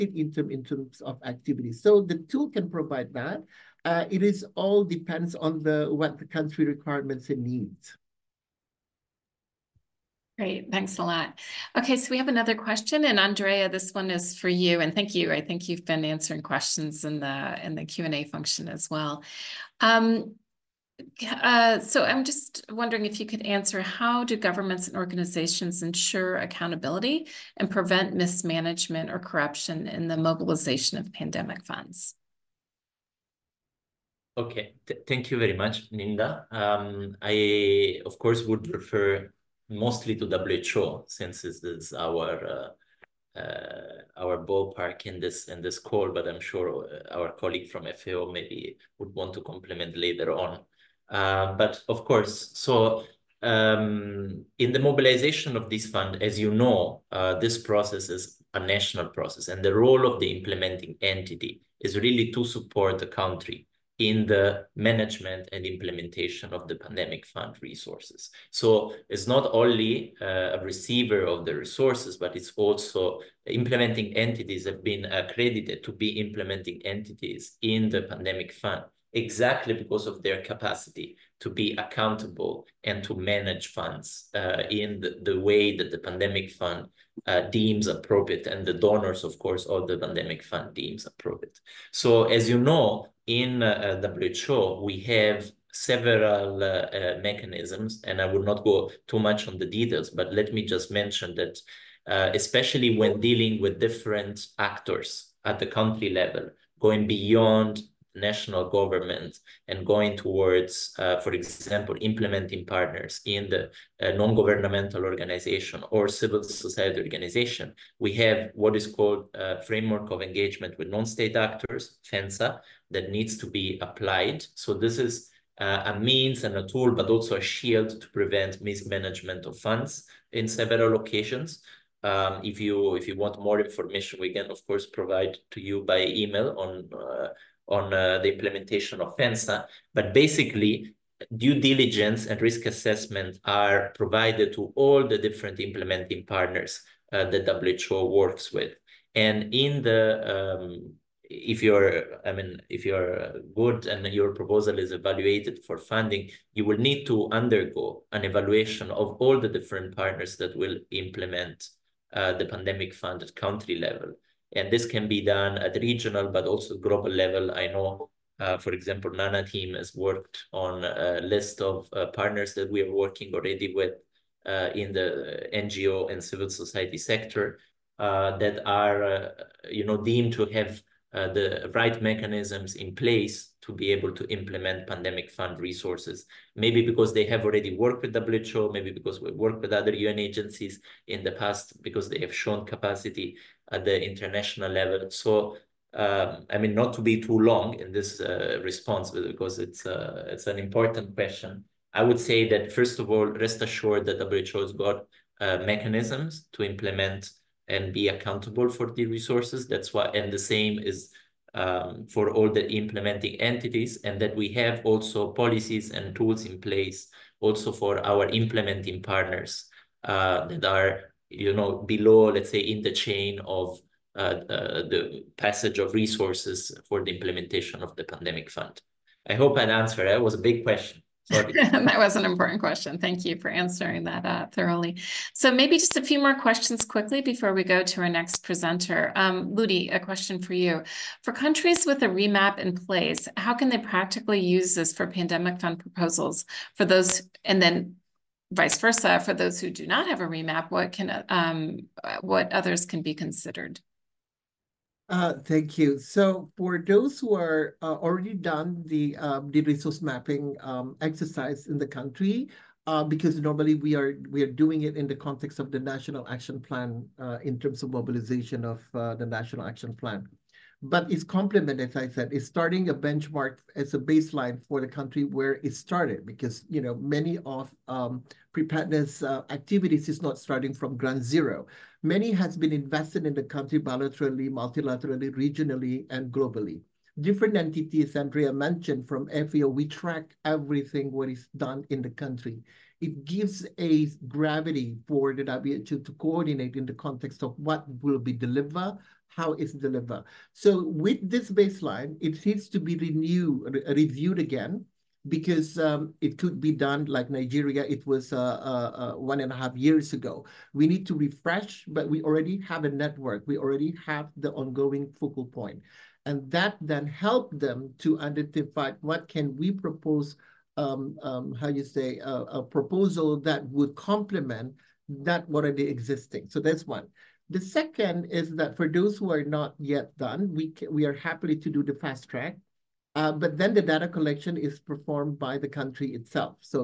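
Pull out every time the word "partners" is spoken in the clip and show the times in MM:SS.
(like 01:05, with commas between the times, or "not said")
01:52, 02:26, 02:39, 02:52, 03:38.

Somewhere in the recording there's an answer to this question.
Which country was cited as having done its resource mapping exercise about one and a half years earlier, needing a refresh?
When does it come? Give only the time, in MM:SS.
05:07.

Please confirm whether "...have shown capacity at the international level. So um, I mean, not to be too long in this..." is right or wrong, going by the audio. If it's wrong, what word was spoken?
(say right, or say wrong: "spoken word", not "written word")
right.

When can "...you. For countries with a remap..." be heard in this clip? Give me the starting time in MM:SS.
04:00.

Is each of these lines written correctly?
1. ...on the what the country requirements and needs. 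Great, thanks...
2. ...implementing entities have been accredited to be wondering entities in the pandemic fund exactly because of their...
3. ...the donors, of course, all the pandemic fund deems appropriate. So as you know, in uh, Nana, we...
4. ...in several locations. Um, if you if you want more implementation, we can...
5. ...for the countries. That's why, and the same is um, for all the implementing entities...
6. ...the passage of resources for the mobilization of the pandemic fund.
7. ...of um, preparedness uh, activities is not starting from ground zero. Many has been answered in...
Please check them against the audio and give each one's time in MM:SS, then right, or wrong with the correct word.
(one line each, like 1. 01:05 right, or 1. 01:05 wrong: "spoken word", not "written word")
1. 00:05 right
2. 01:13 wrong: "implementing", not "wondering"
3. 01:28 wrong: "WHO", not "Nana"
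4. 02:10 wrong: "information", not "implementation"
5. 03:28 wrong: "resources", not "countries"
6. 03:44 wrong: "implementation", not "mobilization"
7. 04:37 wrong: "invested", not "answered".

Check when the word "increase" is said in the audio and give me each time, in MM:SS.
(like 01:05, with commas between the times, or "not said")
not said.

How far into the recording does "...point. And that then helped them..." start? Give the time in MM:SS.
05:15.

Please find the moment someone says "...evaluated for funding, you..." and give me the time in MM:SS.
02:34.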